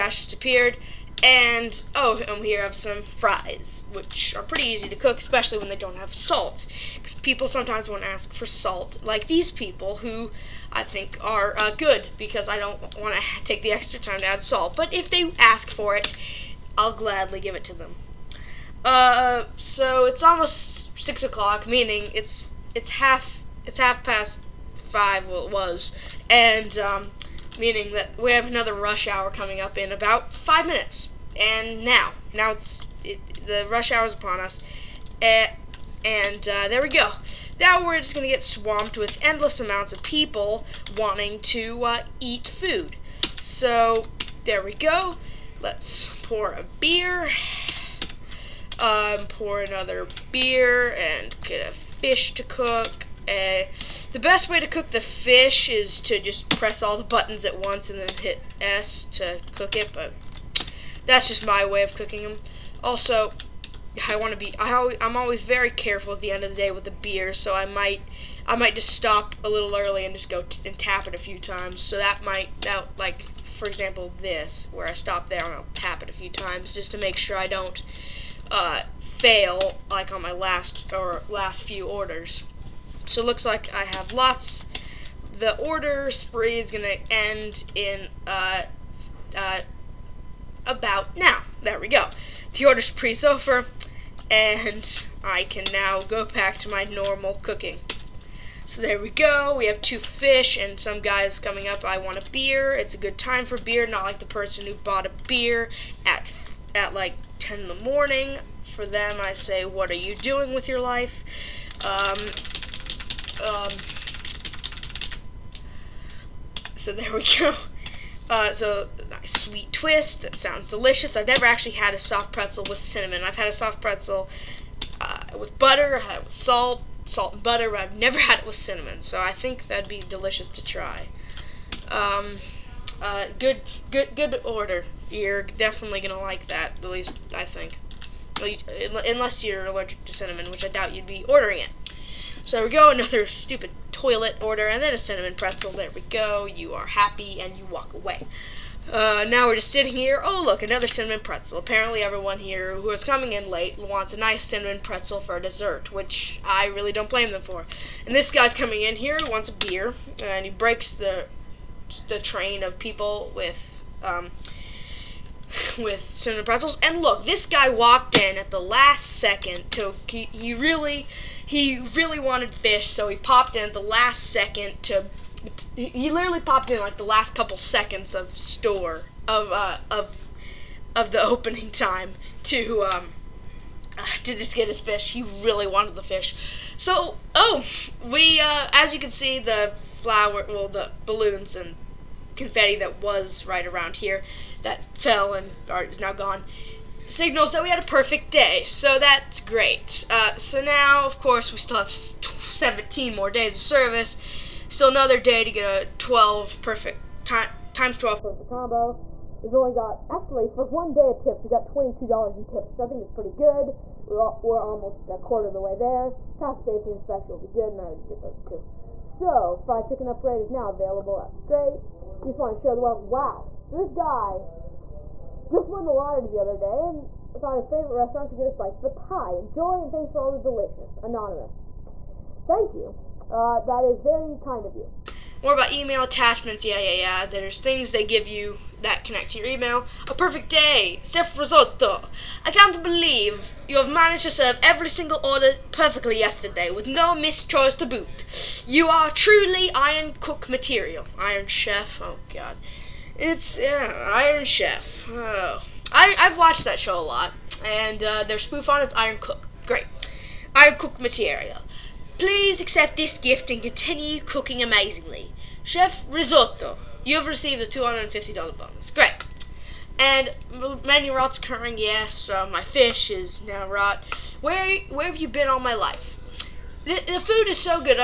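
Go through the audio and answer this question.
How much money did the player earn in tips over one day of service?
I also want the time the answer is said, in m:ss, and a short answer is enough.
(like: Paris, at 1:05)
$22, at 3:31.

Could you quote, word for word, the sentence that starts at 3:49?
Enjoy, and thanks for all the delicious.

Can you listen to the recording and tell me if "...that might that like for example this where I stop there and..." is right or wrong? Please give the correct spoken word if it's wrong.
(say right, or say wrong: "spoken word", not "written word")
right.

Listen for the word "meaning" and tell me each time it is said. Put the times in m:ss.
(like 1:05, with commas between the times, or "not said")
0:21, 0:27.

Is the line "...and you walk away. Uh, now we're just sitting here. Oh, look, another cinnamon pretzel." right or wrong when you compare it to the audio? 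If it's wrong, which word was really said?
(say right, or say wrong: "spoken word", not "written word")
right.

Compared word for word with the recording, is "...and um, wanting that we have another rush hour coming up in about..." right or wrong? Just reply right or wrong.
wrong.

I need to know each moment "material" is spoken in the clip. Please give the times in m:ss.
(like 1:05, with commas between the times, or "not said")
4:10, 4:20.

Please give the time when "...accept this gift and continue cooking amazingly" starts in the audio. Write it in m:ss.
4:22.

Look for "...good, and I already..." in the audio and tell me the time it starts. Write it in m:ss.
3:37.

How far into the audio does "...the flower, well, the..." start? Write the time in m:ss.
3:09.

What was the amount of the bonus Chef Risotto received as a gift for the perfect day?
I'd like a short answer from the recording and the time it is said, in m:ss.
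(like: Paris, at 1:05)
$250, at 4:27.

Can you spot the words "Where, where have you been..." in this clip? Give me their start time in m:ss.
4:34.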